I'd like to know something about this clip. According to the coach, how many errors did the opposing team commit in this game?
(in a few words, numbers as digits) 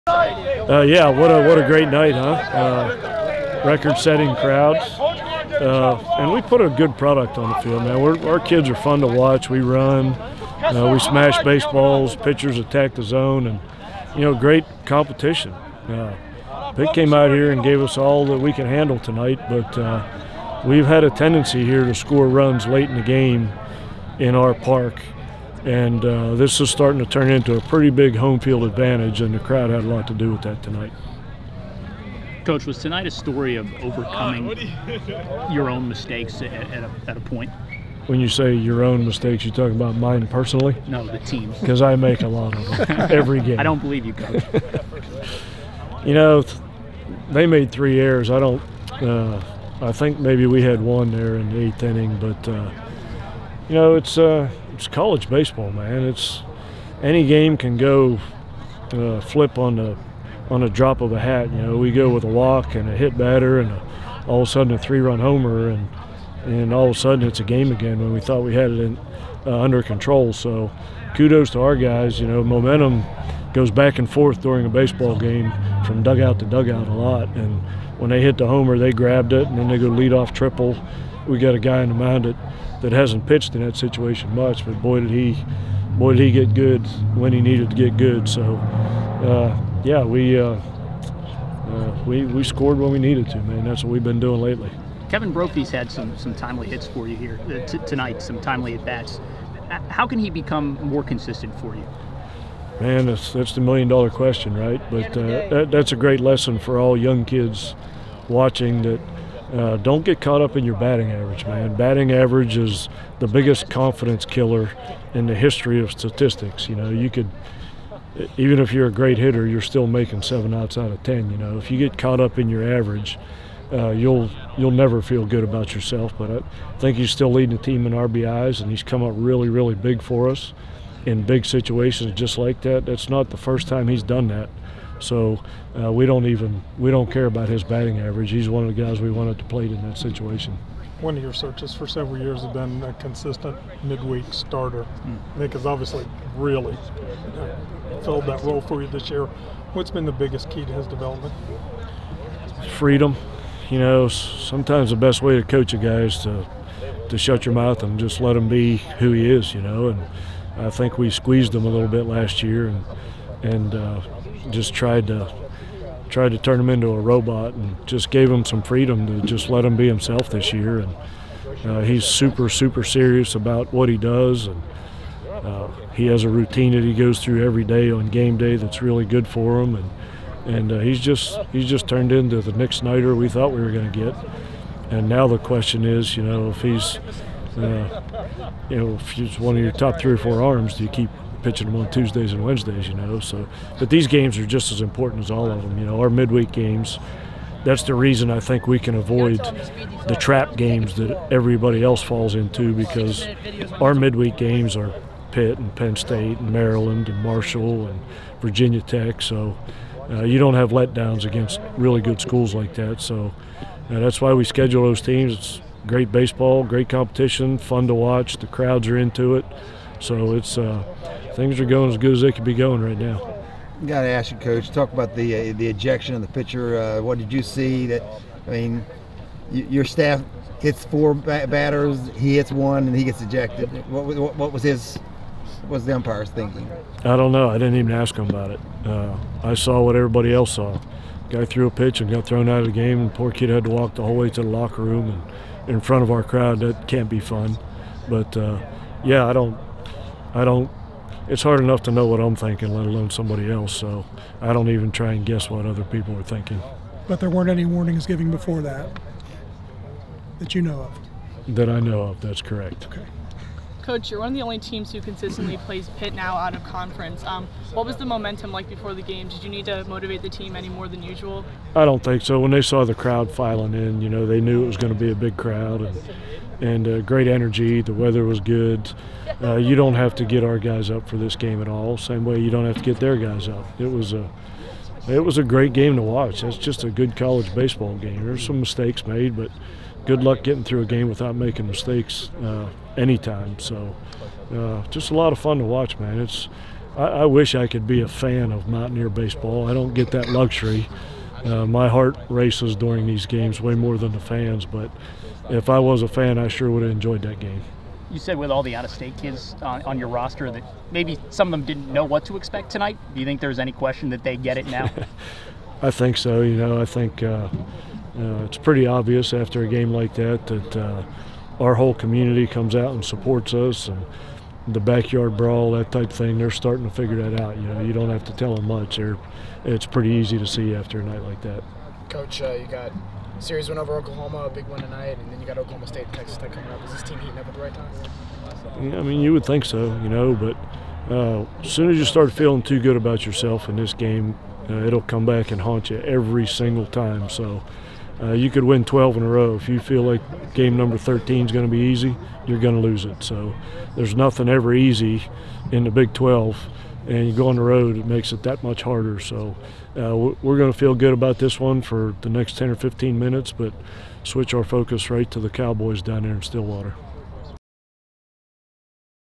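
3.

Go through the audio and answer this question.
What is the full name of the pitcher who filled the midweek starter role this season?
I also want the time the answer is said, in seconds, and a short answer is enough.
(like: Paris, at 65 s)
Nick Snyder, at 182 s.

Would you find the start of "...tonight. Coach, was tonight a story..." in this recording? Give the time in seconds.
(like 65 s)
30 s.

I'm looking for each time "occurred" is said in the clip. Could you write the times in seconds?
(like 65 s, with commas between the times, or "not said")
not said.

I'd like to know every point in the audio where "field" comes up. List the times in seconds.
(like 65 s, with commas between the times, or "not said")
7 s, 28 s.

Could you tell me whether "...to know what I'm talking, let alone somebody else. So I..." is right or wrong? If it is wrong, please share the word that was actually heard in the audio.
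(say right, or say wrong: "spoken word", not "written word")
wrong: "thinking", not "talking".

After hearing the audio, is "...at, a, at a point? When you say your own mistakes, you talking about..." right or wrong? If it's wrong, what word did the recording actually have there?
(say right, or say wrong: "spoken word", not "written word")
right.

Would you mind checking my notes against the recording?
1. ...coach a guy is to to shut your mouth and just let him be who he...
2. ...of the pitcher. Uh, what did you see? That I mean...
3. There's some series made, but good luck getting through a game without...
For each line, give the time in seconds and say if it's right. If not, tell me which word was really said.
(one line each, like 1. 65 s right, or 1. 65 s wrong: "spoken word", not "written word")
1. 155 s right
2. 226 s right
3. 288 s wrong: "mistakes", not "series".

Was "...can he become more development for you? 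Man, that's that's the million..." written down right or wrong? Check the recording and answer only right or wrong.
wrong.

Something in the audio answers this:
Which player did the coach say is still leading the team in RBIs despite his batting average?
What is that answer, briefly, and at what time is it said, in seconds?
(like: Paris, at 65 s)
Kevin Brophy, at 95 s.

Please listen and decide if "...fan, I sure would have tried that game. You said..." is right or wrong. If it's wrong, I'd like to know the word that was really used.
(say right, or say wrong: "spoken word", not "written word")
wrong: "enjoyed", not "tried".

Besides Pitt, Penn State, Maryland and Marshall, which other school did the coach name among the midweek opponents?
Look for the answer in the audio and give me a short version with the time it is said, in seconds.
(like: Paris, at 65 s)
Virginia Tech, at 208 s.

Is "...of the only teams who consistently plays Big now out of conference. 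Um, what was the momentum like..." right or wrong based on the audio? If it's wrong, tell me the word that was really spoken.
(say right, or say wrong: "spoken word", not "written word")
wrong: "Pitt", not "Big".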